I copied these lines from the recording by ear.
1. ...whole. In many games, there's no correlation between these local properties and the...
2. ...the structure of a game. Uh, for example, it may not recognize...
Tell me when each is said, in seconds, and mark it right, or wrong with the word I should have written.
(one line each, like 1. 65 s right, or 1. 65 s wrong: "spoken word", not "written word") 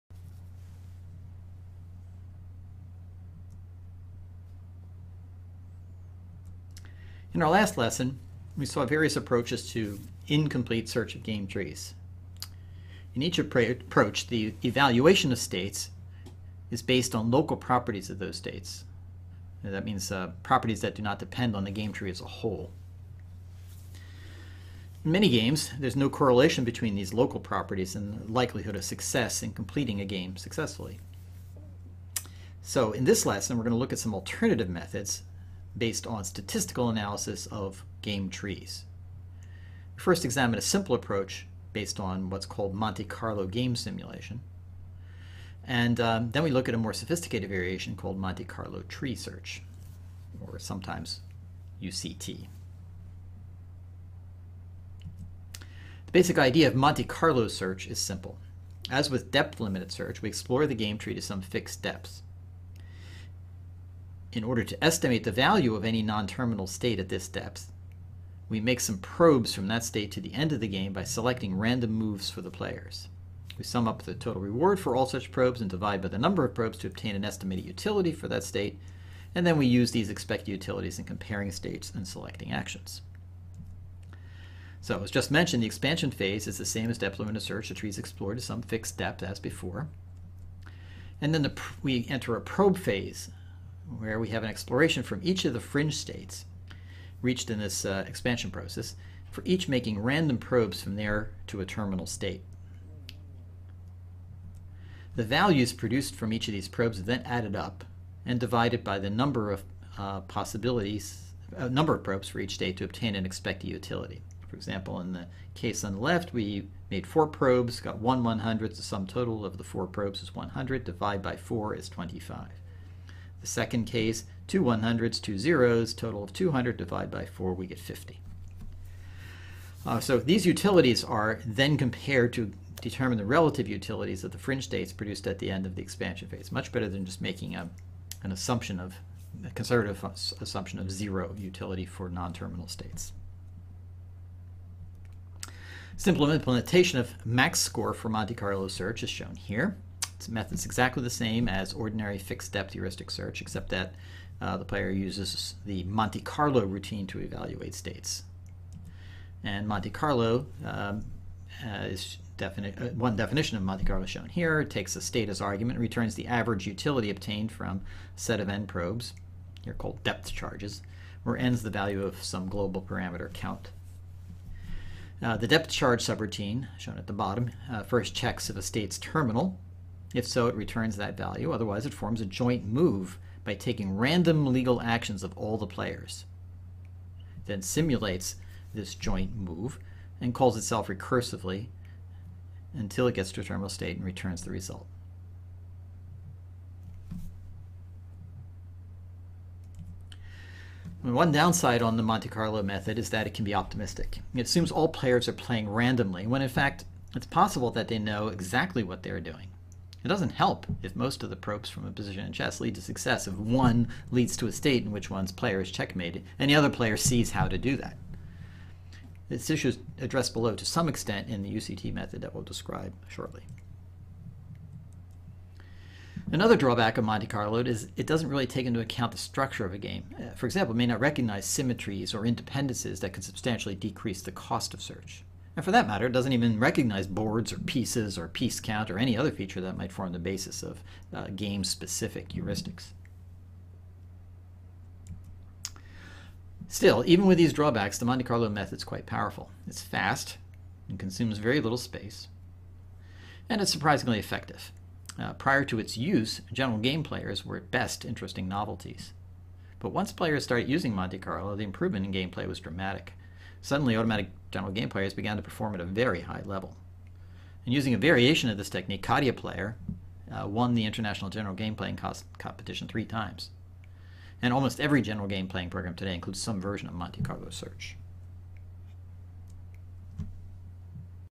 1. 22 s right
2. 229 s right.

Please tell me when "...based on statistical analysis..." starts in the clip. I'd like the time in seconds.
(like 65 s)
35 s.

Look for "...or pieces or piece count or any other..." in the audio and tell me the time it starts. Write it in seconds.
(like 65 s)
237 s.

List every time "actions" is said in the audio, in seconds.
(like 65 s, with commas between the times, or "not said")
82 s, 184 s.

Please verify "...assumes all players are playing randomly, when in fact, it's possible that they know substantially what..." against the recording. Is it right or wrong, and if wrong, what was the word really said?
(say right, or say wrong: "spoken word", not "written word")
wrong: "exactly", not "substantially".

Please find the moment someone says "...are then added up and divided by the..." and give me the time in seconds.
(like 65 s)
106 s.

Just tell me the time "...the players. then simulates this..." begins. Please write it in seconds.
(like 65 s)
185 s.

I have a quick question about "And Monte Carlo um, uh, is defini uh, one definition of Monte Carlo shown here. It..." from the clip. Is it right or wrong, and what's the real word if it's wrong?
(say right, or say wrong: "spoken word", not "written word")
right.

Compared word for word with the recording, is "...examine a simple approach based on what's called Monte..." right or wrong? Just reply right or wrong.
right.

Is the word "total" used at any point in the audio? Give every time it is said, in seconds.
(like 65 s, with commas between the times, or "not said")
74 s, 119 s, 125 s.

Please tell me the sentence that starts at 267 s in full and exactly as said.
And using a variation of this technique, CadiaPlayer uh, won the International General Game Playing Competition three times.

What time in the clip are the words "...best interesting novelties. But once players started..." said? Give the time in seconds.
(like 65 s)
257 s.